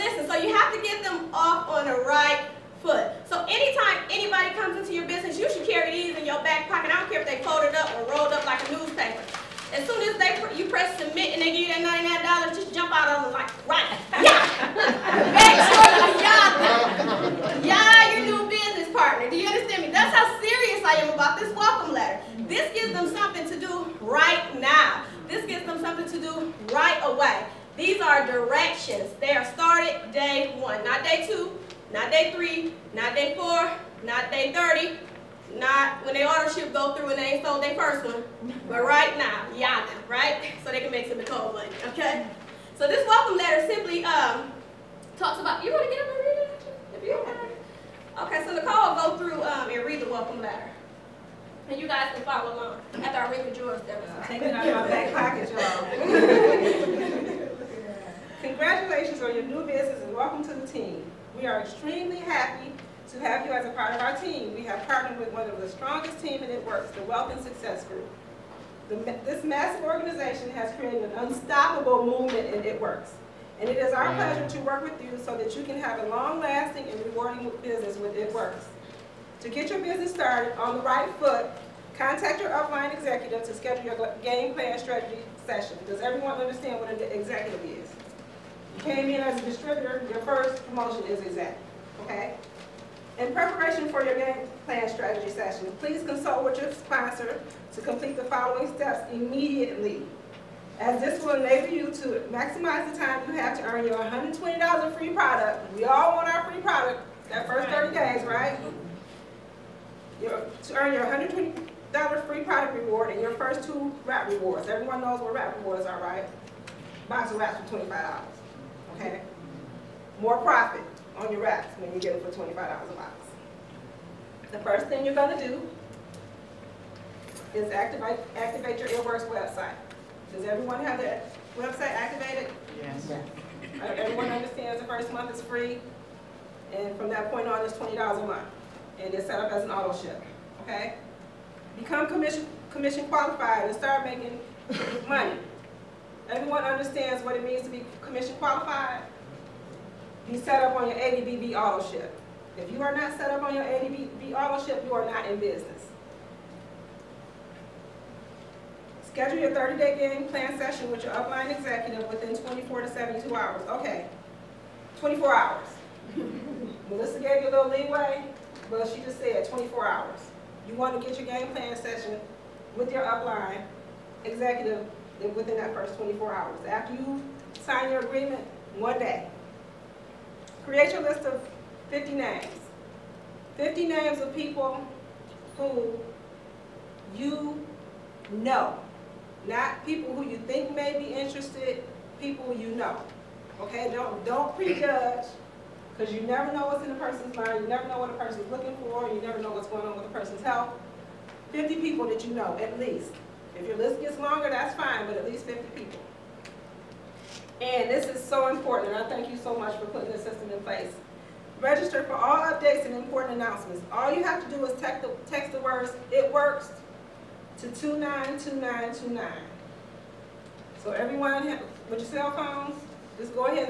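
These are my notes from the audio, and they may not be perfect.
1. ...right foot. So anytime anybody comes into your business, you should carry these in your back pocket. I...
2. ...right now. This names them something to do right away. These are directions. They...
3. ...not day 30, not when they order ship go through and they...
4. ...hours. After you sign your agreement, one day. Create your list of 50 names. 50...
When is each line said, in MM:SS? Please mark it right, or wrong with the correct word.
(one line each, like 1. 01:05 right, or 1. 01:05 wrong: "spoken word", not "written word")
1. 00:02 right
2. 00:24 wrong: "gives", not "names"
3. 00:34 right
4. 02:56 right.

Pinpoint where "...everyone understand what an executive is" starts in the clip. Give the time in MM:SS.
01:26.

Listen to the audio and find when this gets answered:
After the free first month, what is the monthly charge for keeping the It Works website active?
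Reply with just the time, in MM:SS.
02:17.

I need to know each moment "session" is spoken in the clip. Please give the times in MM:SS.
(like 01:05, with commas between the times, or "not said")
01:25, 01:35, 02:40, 02:51.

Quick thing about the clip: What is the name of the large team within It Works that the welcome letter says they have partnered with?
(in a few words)
Wealth and Success Group.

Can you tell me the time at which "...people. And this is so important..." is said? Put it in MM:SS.
03:25.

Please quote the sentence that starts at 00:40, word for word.
So they can make some cold money, okay?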